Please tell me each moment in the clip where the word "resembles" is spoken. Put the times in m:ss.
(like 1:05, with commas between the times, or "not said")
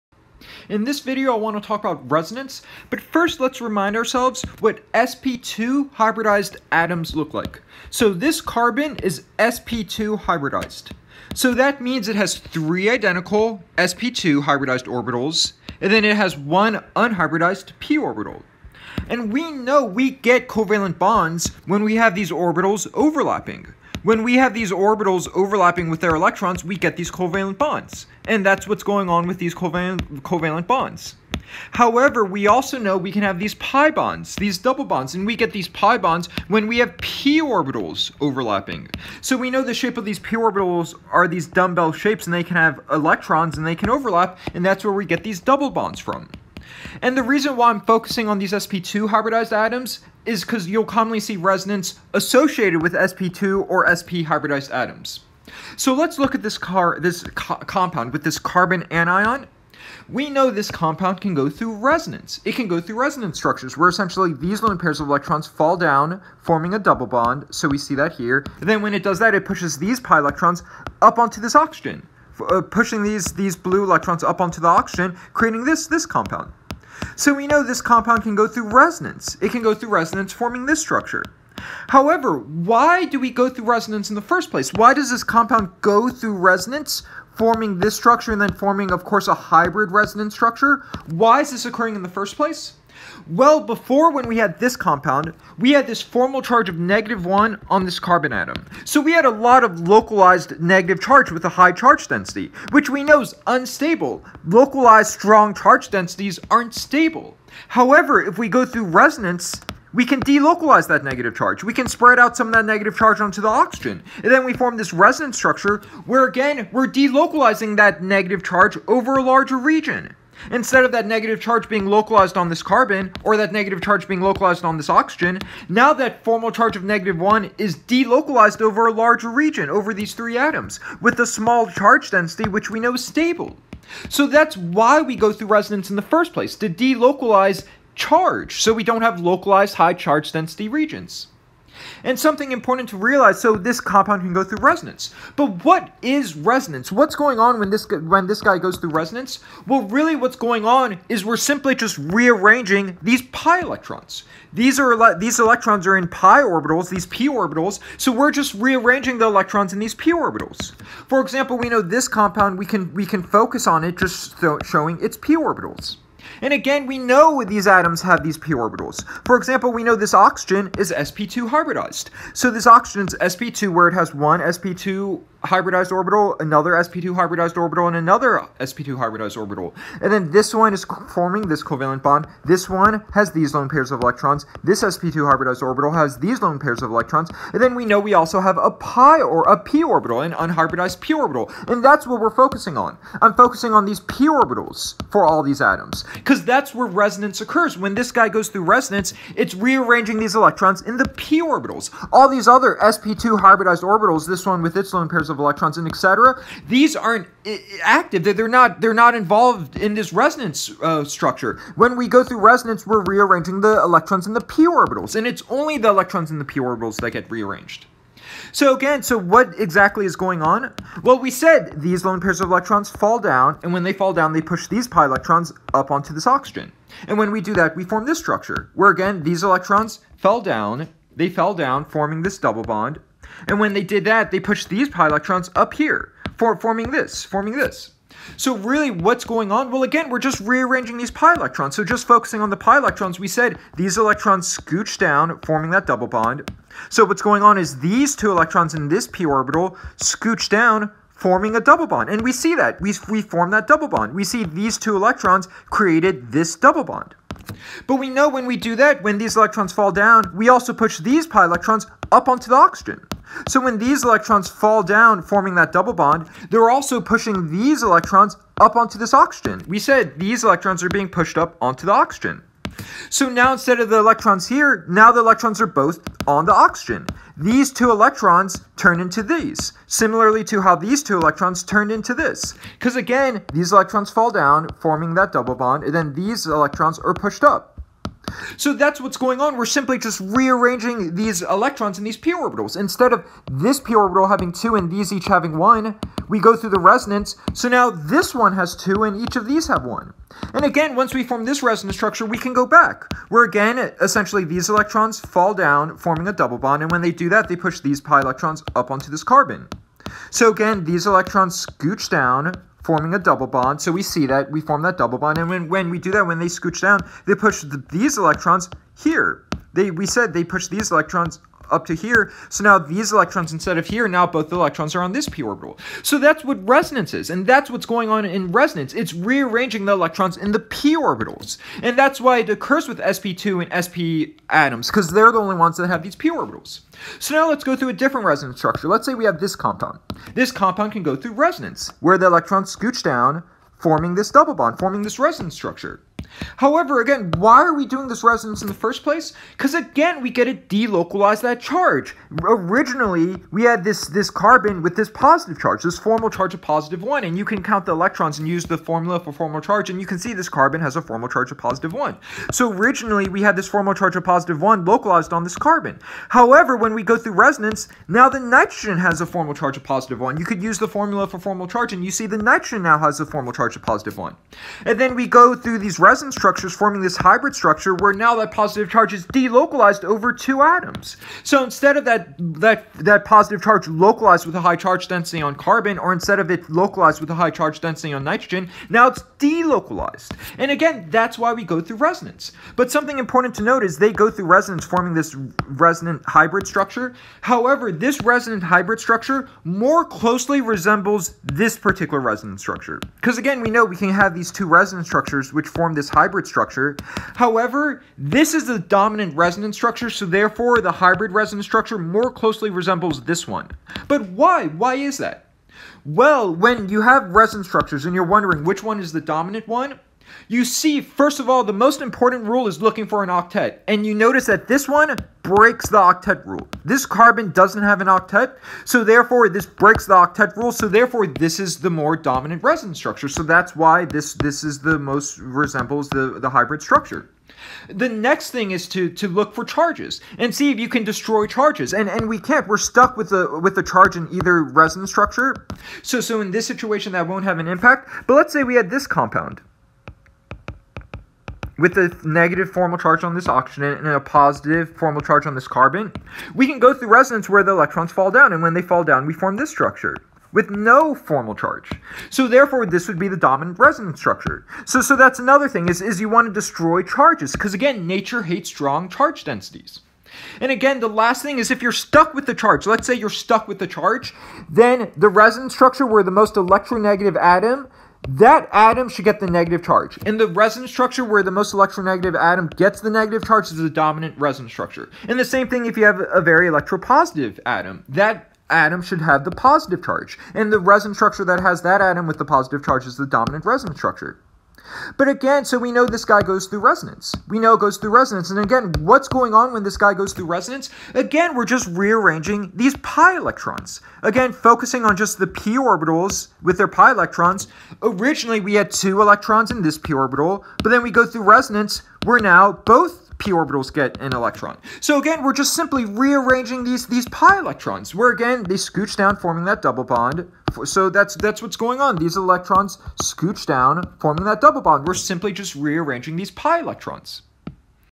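6:40, 6:52, 7:15.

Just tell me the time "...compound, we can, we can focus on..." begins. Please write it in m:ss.
2:42.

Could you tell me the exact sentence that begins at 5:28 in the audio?
It's rearranging the electrons in the p orbitals.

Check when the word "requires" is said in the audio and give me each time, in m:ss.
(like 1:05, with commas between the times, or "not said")
not said.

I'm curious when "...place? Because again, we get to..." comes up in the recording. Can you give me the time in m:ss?
5:49.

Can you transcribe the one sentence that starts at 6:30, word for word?
And again, that's why we go through resonance.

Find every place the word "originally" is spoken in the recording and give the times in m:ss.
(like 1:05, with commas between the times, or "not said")
5:52, 6:02, 8:28.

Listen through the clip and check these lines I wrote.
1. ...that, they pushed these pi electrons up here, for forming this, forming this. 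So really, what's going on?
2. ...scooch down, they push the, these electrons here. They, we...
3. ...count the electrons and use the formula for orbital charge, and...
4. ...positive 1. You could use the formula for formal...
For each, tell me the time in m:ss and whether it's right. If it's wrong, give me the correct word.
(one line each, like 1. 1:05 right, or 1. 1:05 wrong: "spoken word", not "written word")
1. 3:54 right
2. 5:16 right
3. 5:57 wrong: "formal", not "orbital"
4. 6:09 right.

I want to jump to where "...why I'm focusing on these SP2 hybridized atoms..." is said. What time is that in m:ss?
0:47.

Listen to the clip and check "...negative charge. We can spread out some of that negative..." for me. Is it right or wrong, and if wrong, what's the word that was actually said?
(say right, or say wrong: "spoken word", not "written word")
right.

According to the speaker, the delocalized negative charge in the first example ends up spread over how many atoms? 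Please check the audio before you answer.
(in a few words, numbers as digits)
3.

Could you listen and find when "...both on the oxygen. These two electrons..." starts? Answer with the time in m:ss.
4:35.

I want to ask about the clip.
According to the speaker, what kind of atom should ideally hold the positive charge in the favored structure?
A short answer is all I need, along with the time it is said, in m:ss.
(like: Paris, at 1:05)
very electropositive atom, at 8:06.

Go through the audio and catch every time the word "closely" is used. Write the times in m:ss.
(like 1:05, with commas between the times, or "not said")
6:40, 6:52.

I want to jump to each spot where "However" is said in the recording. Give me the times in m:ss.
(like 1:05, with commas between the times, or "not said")
0:31, 1:21, 1:47, 5:46, 6:06, 6:37, 6:47.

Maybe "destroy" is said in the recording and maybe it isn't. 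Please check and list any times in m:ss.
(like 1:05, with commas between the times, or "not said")
7:21, 7:46.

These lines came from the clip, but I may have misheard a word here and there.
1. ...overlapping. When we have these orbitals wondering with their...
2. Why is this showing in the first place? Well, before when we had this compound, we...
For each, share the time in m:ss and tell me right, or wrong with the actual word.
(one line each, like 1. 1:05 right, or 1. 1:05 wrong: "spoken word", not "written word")
1. 0:22 wrong: "overlapping", not "wondering"
2. 1:31 wrong: "occurring", not "showing".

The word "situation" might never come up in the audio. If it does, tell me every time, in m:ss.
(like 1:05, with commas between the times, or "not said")
7:26.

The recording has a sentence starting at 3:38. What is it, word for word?
So again, so what exactly is going on?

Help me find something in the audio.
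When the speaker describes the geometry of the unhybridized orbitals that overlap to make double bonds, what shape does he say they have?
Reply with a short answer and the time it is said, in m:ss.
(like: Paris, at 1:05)
dumbbell shapes, at 0:41.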